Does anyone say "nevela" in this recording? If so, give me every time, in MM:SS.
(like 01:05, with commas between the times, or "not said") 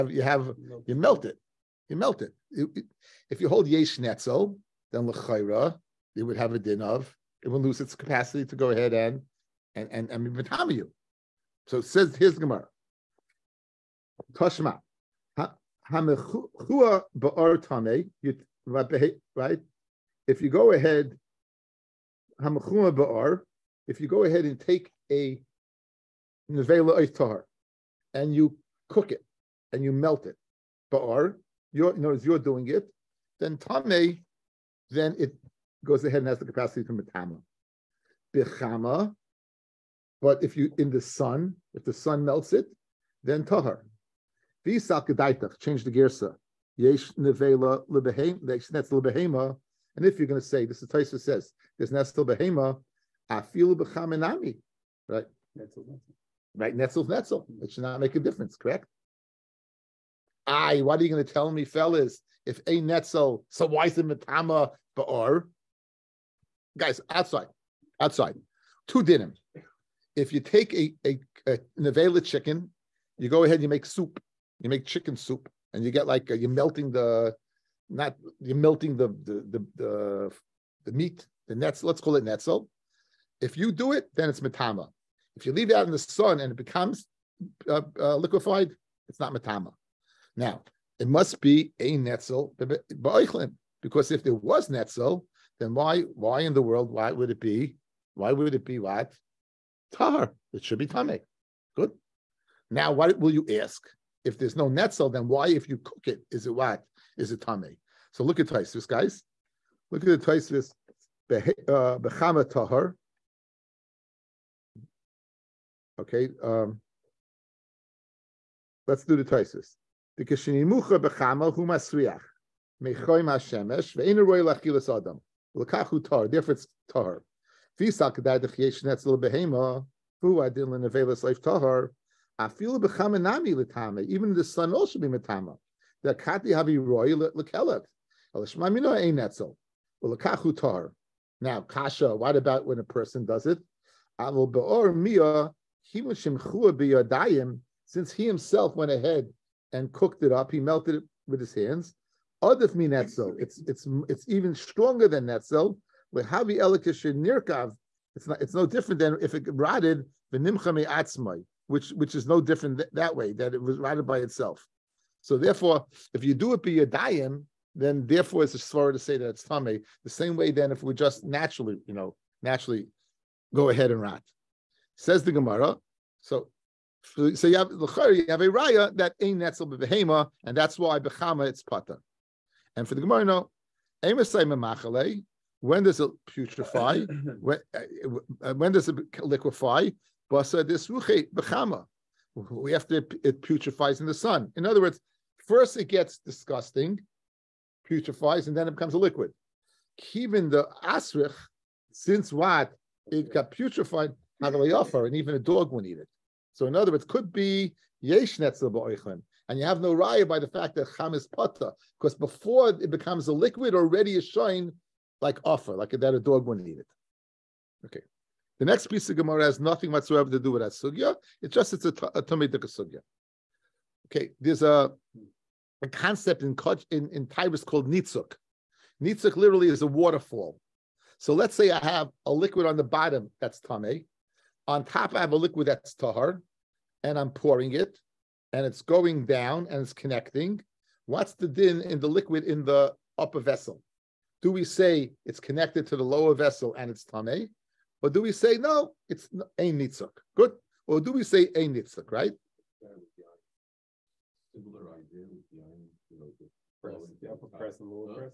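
00:26, 00:47.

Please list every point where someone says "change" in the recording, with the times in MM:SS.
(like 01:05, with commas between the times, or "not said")
00:45.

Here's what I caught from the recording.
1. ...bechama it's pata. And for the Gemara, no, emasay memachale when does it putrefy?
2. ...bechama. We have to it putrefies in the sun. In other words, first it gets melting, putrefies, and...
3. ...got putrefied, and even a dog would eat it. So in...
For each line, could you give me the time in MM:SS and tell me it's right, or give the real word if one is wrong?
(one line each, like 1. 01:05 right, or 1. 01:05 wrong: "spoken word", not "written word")
1. 03:01 right
2. 03:11 wrong: "disgusting", not "melting"
3. 03:23 right.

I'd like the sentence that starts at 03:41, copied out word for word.
It's just it's a, t- a tummy sugya.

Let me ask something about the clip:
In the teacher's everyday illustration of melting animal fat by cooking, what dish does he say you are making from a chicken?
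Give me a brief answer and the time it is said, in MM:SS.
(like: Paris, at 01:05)
Chicken soup, at 01:14.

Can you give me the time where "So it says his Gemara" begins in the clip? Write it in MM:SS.
00:11.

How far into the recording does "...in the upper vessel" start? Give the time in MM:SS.
04:02.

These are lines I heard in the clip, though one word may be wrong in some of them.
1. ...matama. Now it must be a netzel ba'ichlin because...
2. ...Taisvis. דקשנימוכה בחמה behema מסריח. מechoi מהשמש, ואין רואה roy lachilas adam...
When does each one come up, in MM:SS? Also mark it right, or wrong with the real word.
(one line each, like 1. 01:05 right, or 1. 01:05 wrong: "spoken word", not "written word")
1. 01:29 right
2. 01:59 wrong: "bechama", not "behema".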